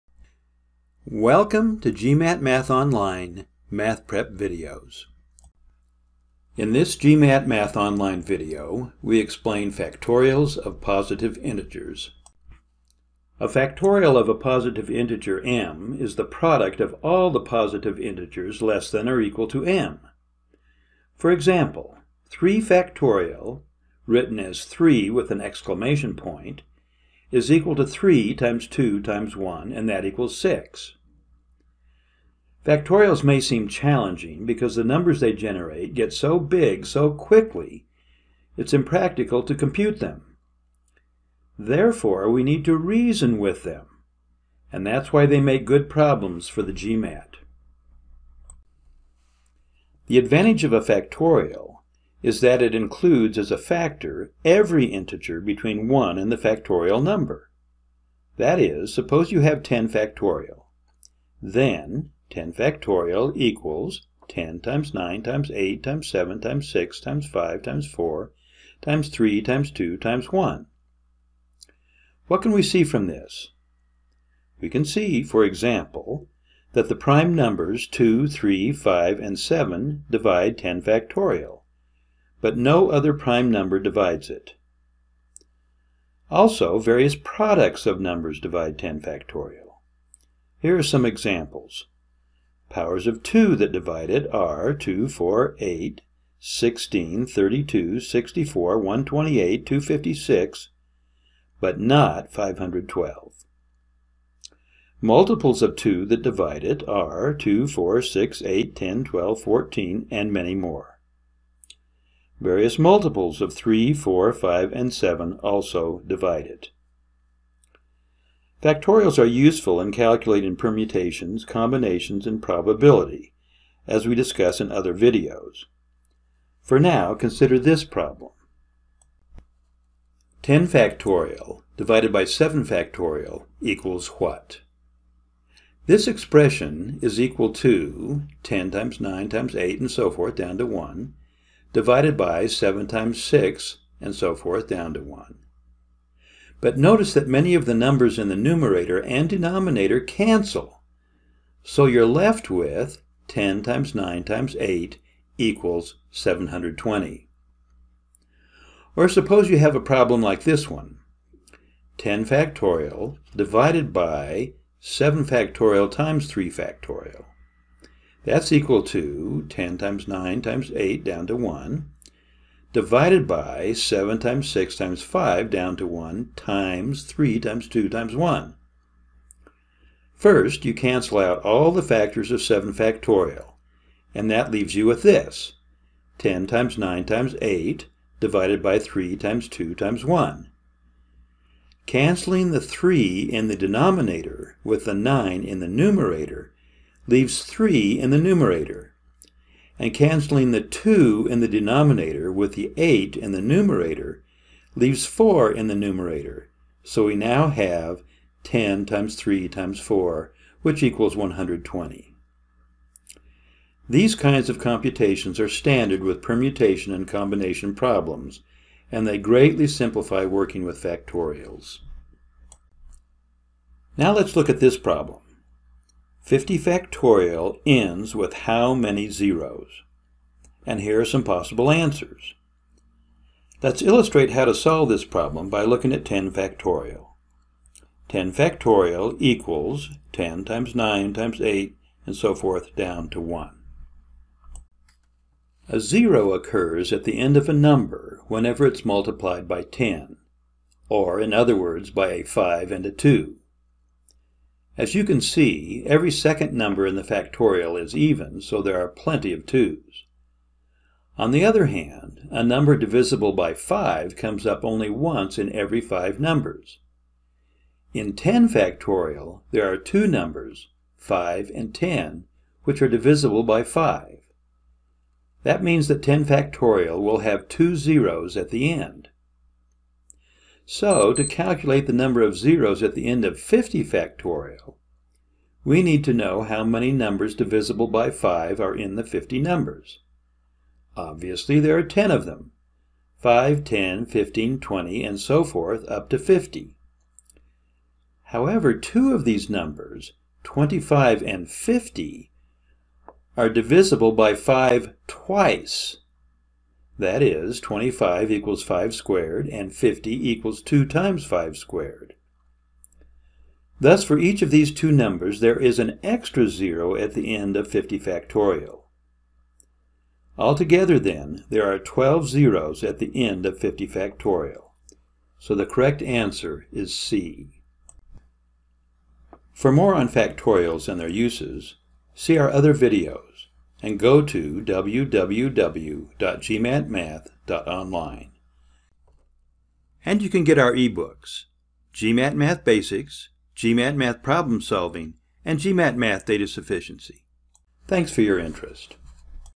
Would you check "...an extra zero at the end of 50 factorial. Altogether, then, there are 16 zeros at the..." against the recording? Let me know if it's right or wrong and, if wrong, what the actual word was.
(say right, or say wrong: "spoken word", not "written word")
wrong: "12", not "16".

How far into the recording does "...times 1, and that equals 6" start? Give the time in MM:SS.
00:29.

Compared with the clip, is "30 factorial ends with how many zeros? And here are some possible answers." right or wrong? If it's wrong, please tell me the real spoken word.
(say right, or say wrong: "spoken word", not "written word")
wrong: "50", not "30".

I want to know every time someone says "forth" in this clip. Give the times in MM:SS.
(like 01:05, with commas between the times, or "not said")
02:20, 02:24, 04:02, 04:55.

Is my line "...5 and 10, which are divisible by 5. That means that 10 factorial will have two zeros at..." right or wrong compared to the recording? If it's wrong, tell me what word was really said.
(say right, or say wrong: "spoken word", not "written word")
right.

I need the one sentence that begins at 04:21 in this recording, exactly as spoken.
On the other hand, a number divisible by 5 comes up only once in every 5 numbers.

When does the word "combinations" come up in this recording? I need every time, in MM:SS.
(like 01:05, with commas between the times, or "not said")
02:01, 03:37.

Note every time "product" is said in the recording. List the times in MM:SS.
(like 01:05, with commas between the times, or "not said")
00:16, 01:27.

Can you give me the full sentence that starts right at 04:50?
Obviously, there are 10 of them.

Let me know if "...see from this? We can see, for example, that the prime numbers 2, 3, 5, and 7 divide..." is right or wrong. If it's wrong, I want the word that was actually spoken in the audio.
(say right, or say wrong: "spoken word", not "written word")
right.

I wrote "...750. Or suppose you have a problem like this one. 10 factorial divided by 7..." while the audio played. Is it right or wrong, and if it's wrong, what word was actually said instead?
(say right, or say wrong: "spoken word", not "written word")
wrong: "720", not "750".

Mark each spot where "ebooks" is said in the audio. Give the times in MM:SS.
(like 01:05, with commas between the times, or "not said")
05:40.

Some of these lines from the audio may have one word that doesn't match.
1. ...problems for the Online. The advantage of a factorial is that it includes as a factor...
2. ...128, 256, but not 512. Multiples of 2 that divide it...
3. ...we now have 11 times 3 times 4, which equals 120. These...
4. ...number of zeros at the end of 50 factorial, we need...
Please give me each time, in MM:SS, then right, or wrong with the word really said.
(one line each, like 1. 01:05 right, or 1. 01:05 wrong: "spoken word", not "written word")
1. 00:45 wrong: "GMAT", not "Online"
2. 01:38 right
3. 03:27 wrong: "10", not "11"
4. 04:41 right.